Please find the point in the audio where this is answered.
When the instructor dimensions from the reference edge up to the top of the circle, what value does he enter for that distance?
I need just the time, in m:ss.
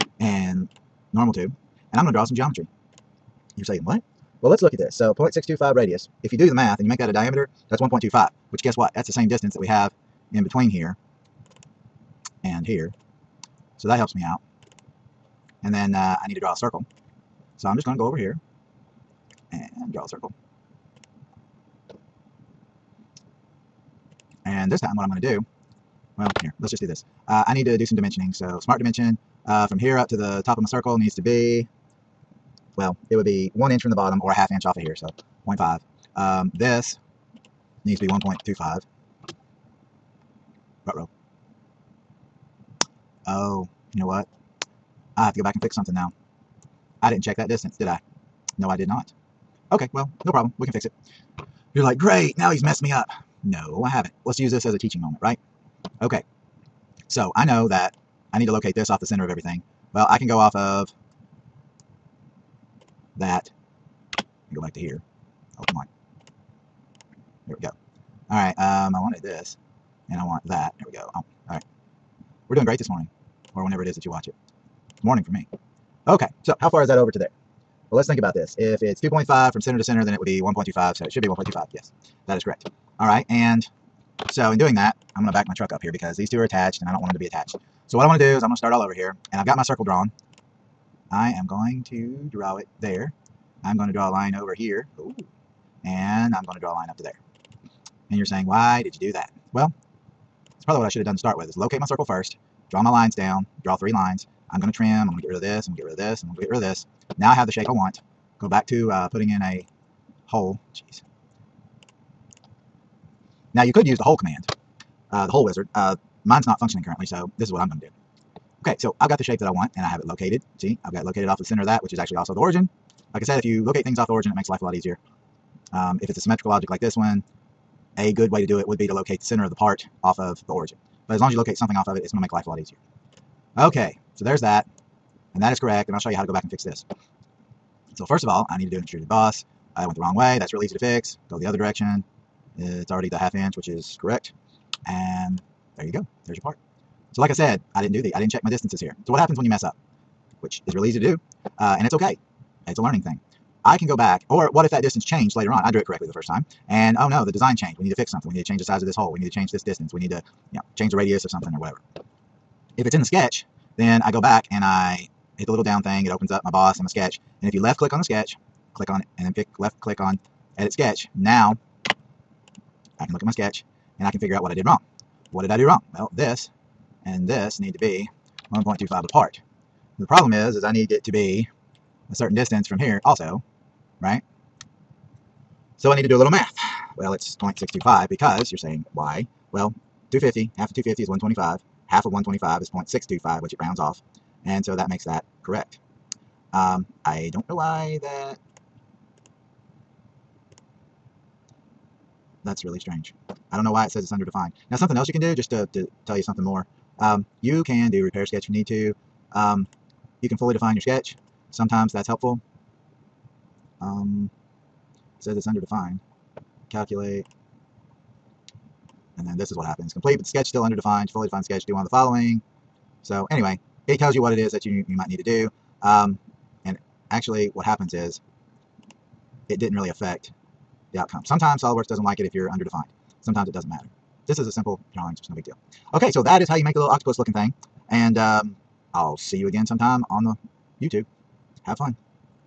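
0:35.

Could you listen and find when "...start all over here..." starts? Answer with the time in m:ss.
1:28.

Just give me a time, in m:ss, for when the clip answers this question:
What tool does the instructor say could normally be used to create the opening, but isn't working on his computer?
1:55.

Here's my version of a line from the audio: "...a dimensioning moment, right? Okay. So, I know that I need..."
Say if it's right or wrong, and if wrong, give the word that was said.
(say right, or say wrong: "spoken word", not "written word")
wrong: "teaching", not "dimensioning".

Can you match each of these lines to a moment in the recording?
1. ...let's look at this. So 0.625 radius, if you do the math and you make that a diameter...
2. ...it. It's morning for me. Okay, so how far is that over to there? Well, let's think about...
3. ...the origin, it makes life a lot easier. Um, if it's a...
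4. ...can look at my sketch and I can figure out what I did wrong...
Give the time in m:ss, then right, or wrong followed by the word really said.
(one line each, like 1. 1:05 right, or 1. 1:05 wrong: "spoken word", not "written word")
1. 0:04 right
2. 1:14 right
3. 2:04 right
4. 2:53 right.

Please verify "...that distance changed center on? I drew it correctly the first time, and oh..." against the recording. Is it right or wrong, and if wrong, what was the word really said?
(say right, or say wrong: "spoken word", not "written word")
wrong: "later", not "center".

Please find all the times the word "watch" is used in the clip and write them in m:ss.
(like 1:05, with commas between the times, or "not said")
1:14.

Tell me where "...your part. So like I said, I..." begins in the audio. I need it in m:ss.
2:26.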